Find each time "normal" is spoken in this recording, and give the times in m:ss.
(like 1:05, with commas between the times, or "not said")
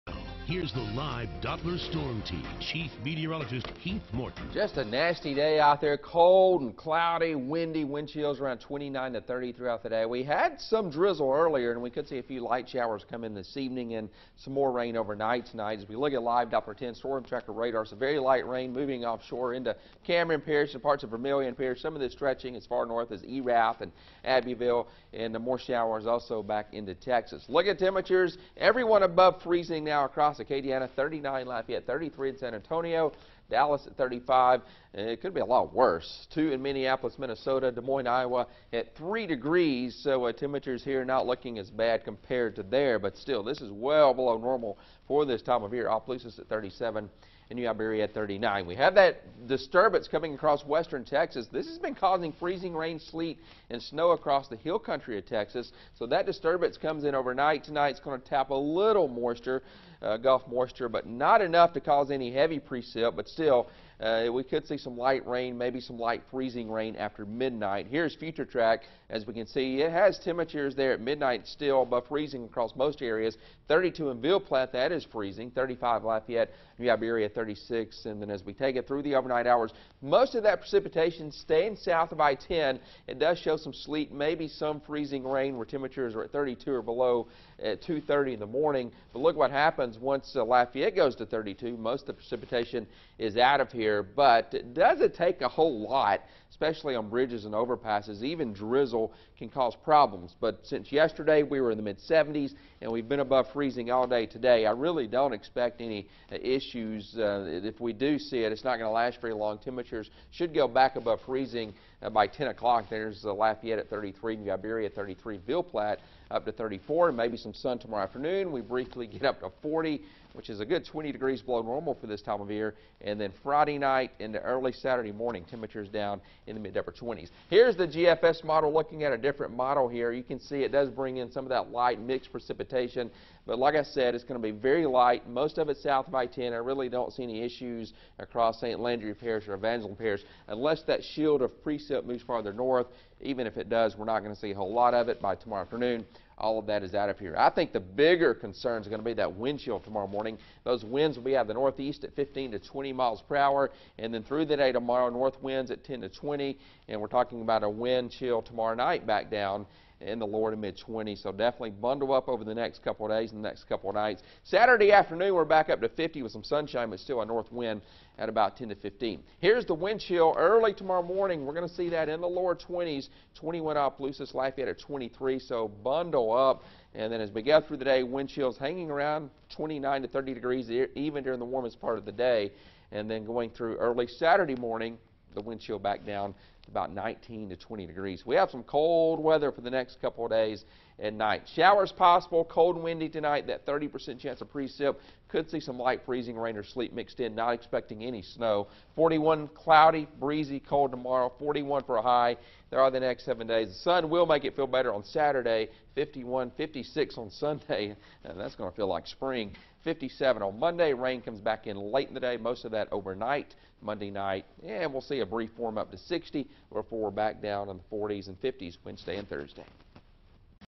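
0:44, 2:01.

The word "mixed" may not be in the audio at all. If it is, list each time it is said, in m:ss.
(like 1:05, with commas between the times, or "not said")
2:11, 3:16.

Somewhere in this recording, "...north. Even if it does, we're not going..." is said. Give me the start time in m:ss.
2:22.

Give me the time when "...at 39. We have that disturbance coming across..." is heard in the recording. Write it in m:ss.
0:48.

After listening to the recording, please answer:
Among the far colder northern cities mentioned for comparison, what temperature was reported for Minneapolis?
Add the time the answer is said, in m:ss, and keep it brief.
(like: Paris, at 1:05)
2, at 0:36.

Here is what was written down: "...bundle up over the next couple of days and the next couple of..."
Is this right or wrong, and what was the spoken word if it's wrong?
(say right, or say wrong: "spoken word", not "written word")
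right.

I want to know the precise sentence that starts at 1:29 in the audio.
But look what happens once uh, Lafayette goes to 32.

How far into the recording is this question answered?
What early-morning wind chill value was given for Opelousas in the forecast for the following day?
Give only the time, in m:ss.
2:53.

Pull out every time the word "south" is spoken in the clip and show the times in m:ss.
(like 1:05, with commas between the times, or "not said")
1:21, 2:15.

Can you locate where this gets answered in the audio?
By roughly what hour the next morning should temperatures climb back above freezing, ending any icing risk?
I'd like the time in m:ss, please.
1:52.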